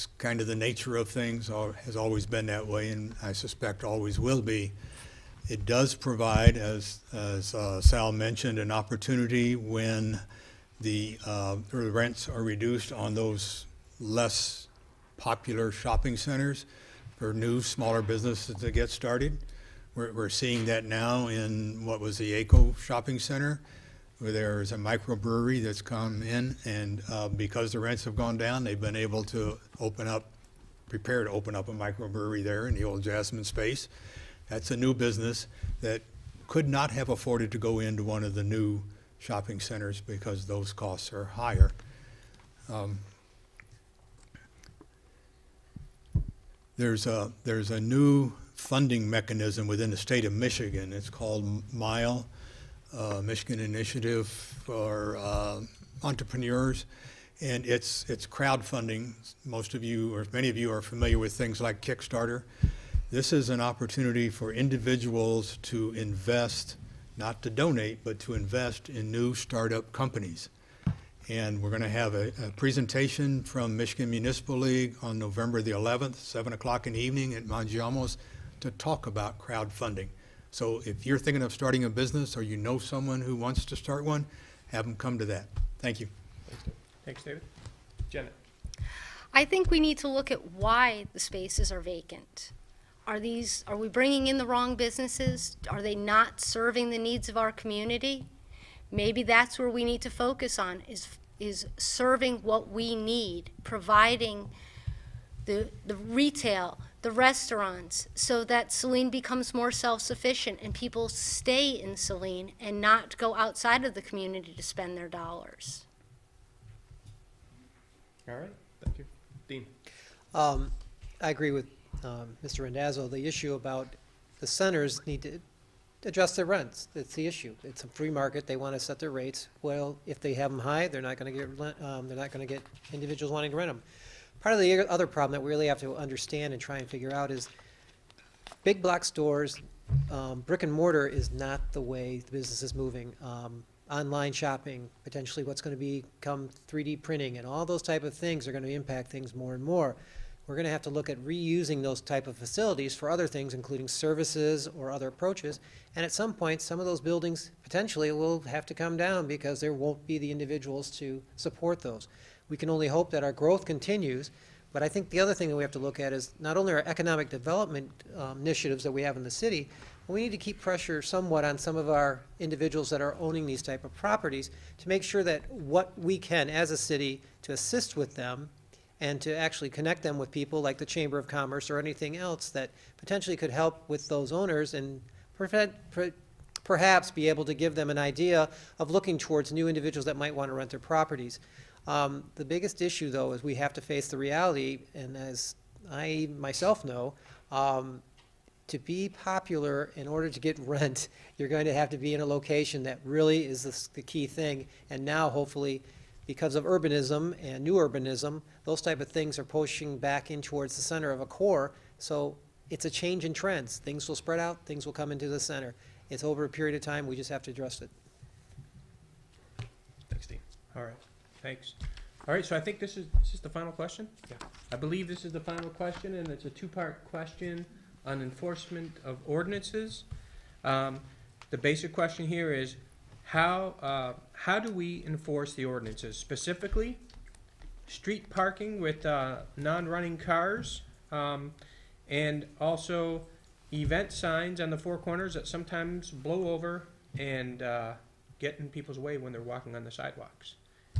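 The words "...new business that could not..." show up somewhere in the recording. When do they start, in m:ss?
0:34.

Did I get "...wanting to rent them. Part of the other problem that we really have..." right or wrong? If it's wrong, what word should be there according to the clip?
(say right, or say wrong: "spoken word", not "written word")
right.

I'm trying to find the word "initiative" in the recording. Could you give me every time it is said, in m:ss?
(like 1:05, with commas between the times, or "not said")
0:53, 2:48.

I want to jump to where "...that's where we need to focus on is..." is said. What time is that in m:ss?
1:39.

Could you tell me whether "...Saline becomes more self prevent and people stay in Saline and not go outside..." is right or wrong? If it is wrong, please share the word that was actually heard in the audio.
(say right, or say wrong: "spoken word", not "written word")
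wrong: "sufficient", not "prevent".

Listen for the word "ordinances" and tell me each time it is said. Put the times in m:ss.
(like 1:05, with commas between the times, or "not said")
3:49, 3:55.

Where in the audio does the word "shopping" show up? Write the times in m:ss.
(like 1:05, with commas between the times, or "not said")
0:15, 0:22, 0:39, 2:24.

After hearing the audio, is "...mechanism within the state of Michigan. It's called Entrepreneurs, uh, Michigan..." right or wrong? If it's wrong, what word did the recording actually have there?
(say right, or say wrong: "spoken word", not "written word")
wrong: "MILE", not "Entrepreneurs".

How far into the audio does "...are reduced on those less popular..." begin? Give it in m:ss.
0:12.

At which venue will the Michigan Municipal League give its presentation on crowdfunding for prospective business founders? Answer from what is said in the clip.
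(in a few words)
Mangiamo's.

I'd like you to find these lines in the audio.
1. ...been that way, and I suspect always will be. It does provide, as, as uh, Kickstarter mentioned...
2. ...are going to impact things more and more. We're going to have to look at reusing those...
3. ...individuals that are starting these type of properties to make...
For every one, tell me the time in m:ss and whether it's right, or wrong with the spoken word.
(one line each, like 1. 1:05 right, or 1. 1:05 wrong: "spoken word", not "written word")
1. 0:02 wrong: "Sal", not "Kickstarter"
2. 2:28 right
3. 2:52 wrong: "owning", not "starting".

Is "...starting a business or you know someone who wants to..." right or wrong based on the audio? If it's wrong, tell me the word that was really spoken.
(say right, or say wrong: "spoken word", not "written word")
right.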